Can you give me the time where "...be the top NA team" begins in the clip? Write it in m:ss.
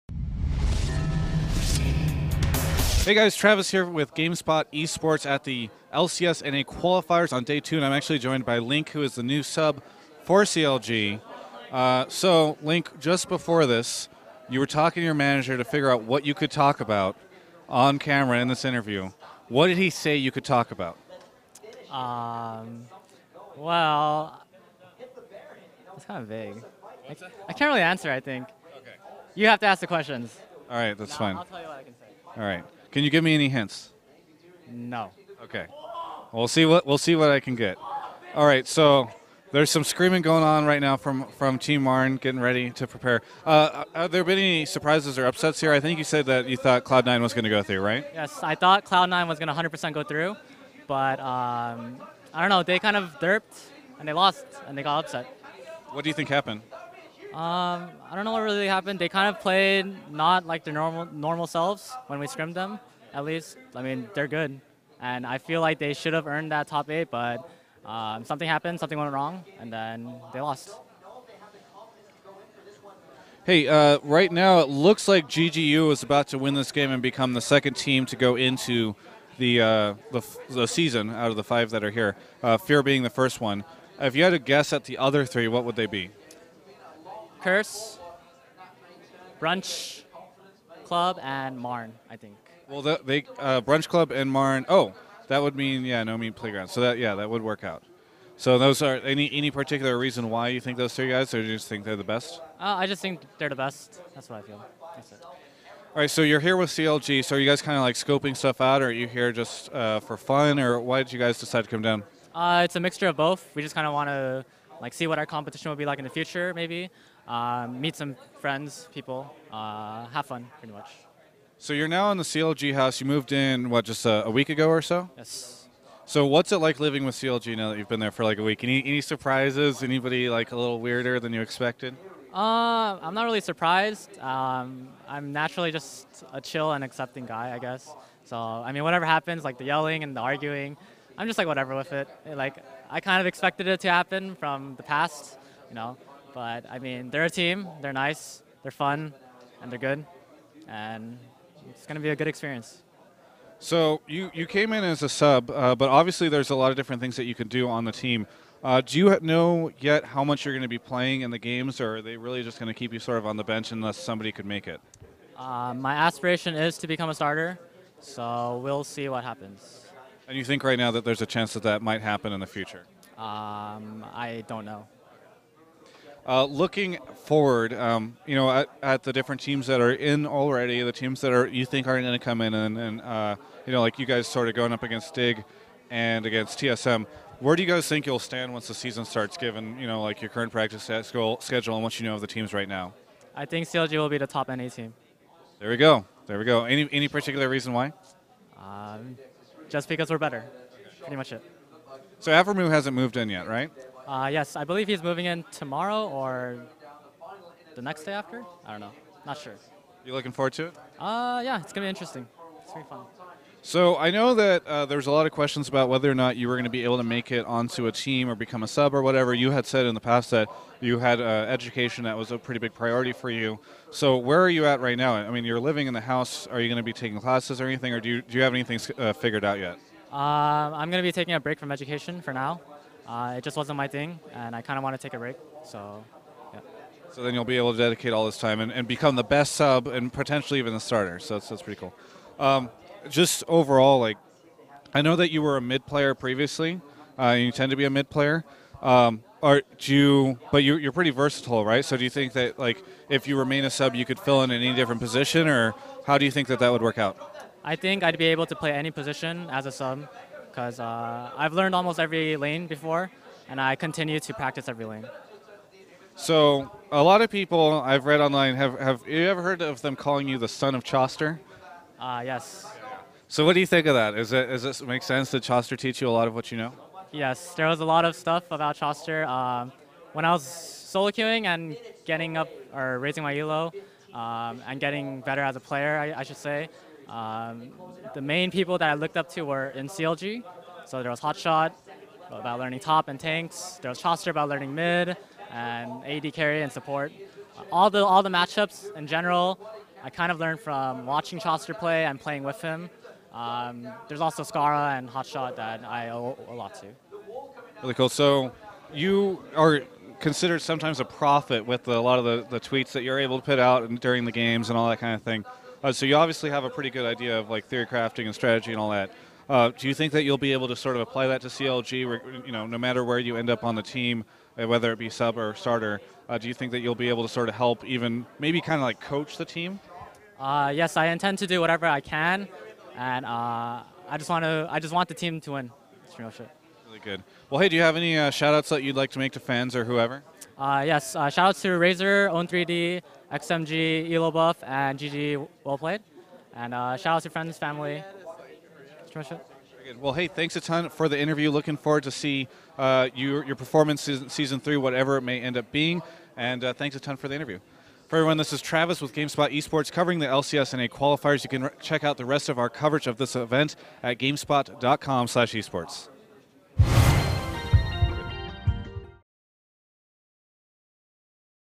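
3:14.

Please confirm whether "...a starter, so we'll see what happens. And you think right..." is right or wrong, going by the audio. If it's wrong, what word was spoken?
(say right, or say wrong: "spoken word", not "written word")
right.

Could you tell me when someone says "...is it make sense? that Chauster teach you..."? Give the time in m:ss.
4:34.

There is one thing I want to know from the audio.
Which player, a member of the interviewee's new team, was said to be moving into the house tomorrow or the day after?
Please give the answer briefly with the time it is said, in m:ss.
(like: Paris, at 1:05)
Aphromoo, at 3:22.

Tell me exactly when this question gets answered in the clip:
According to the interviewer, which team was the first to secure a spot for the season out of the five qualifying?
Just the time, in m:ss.
1:22.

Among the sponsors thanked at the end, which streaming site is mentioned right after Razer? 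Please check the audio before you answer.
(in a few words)
Own3D.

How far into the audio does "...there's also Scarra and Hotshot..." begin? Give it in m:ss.
5:04.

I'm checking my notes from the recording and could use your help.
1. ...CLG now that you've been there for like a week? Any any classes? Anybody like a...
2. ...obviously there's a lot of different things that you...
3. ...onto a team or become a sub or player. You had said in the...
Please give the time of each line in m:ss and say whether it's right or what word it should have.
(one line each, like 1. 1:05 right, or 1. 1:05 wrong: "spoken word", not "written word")
1. 2:07 wrong: "surprises", not "classes"
2. 2:35 right
3. 3:37 wrong: "whatever", not "player".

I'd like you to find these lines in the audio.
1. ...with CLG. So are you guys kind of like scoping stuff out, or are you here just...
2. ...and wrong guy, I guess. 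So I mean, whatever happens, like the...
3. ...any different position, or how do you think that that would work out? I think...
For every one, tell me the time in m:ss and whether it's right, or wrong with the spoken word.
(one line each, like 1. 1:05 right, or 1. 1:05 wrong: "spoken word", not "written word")
1. 1:46 right
2. 2:16 wrong: "accepting", not "wrong"
3. 4:14 right.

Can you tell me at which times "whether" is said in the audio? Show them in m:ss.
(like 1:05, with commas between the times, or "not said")
3:35, 5:24.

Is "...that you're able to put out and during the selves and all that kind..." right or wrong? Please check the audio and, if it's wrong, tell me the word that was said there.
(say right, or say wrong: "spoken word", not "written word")
wrong: "games", not "selves".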